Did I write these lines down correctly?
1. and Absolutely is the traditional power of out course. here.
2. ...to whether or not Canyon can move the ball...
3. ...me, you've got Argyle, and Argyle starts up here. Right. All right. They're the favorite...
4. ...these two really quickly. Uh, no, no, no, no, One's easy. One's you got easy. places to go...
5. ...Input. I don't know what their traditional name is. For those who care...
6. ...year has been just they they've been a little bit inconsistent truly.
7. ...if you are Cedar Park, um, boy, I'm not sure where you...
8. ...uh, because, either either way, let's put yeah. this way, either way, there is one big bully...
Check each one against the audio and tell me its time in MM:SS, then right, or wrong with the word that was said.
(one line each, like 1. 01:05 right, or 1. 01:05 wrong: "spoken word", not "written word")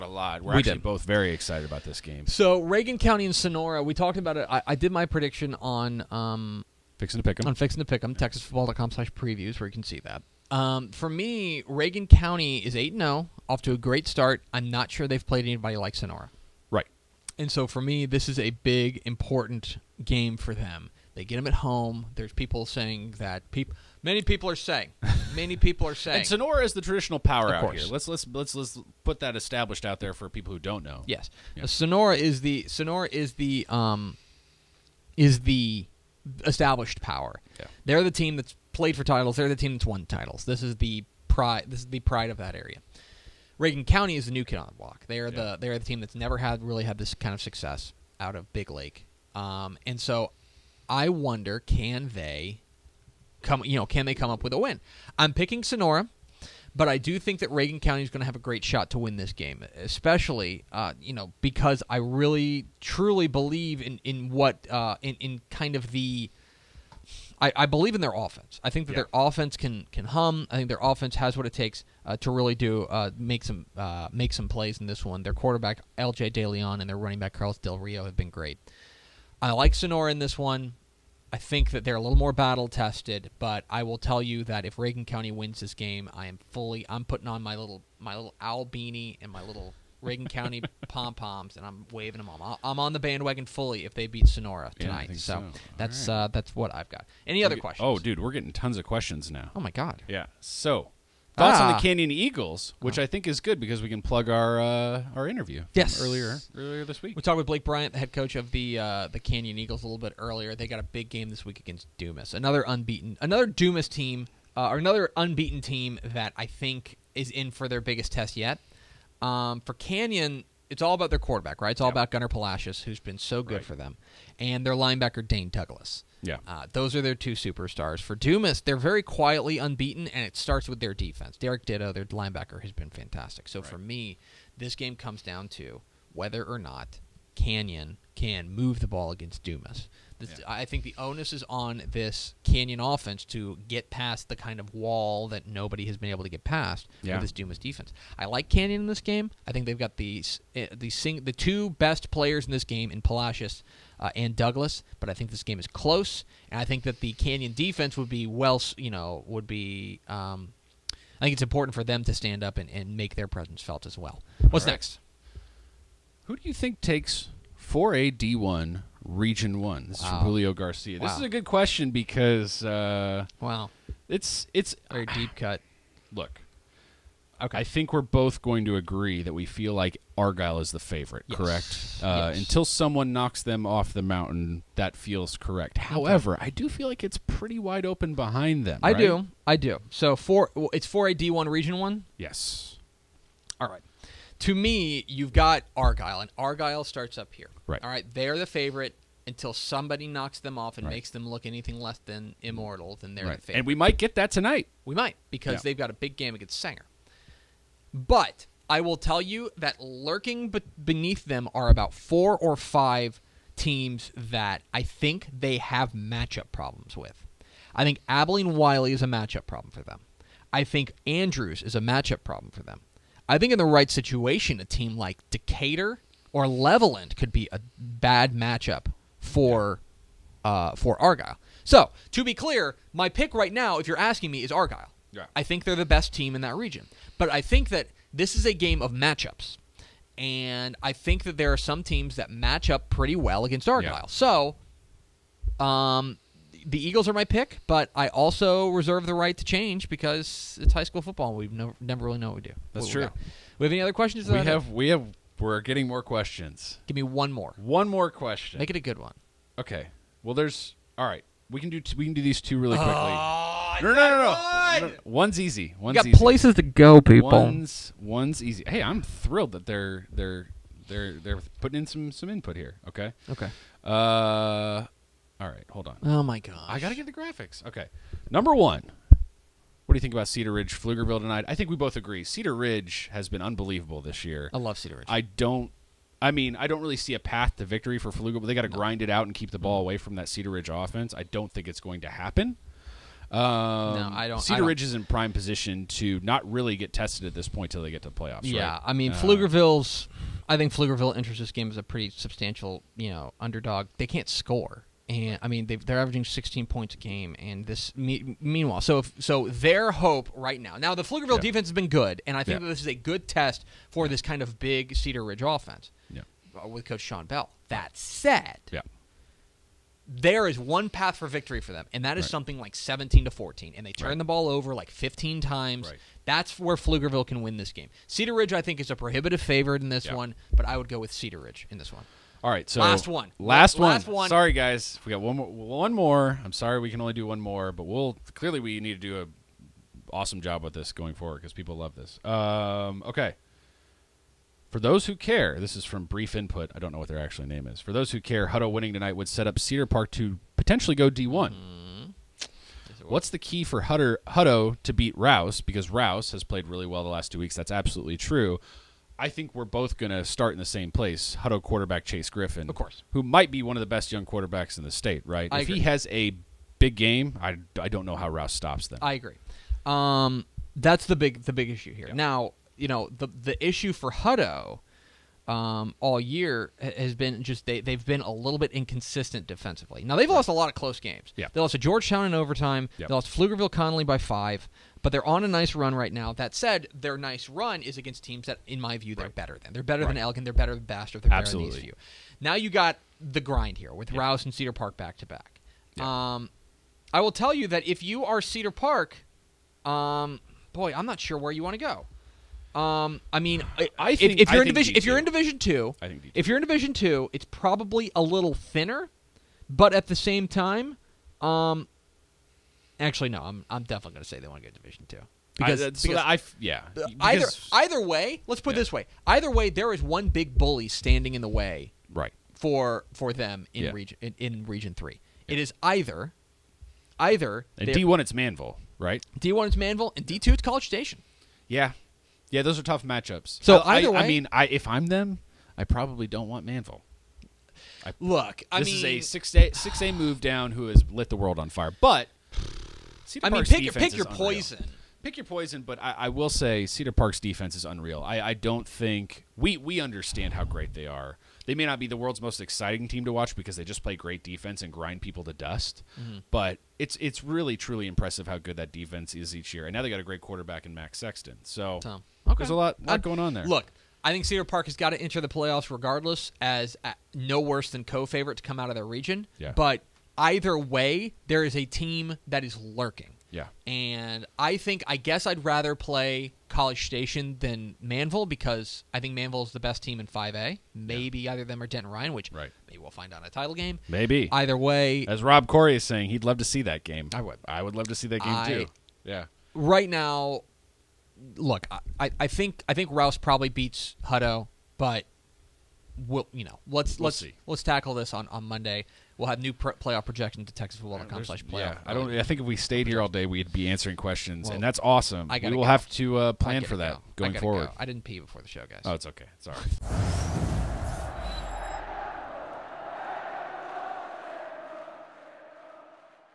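1. 00:26 wrong: "Sonora", not "Absolutely"
2. 02:15 right
3. 03:14 right
4. 04:22 right
5. 05:46 wrong: "actual", not "traditional"
6. 06:16 wrong: "defensively", not "truly"
7. 06:37 right
8. 06:56 right.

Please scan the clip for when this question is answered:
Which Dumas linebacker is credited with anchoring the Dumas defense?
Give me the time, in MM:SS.
02:11.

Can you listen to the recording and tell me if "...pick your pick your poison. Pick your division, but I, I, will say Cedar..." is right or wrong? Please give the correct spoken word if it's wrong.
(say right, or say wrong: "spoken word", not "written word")
wrong: "poison", not "division".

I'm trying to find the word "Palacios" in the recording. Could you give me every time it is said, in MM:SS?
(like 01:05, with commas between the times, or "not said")
02:02, 02:33.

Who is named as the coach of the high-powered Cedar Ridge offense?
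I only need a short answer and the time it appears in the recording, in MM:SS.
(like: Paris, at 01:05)
Sean Bell, at 05:16.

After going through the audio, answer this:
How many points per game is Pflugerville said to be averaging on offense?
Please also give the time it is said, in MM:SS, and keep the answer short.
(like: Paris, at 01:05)
16, at 05:06.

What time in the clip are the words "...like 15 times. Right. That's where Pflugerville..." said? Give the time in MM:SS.
05:24.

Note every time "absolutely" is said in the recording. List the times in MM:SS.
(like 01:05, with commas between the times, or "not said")
05:57, 06:31.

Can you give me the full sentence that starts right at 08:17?
let's tackle this on on Monday we'll have new playoff projections to texasfootball.com slash playoff.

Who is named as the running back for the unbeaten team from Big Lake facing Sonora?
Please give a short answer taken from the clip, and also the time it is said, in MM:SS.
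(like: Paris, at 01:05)
Carlos Del Rio, at 01:17.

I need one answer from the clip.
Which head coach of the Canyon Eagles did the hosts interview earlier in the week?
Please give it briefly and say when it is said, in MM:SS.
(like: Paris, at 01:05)
Blake Bryant, at 01:47.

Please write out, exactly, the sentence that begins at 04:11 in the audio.
We no, never really know what we do.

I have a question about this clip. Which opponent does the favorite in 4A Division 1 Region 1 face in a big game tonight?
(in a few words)
Sanger.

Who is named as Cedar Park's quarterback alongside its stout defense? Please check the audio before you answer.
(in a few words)
Max Sexton.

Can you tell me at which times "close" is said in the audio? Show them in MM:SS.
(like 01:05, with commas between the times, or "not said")
02:35, 06:20.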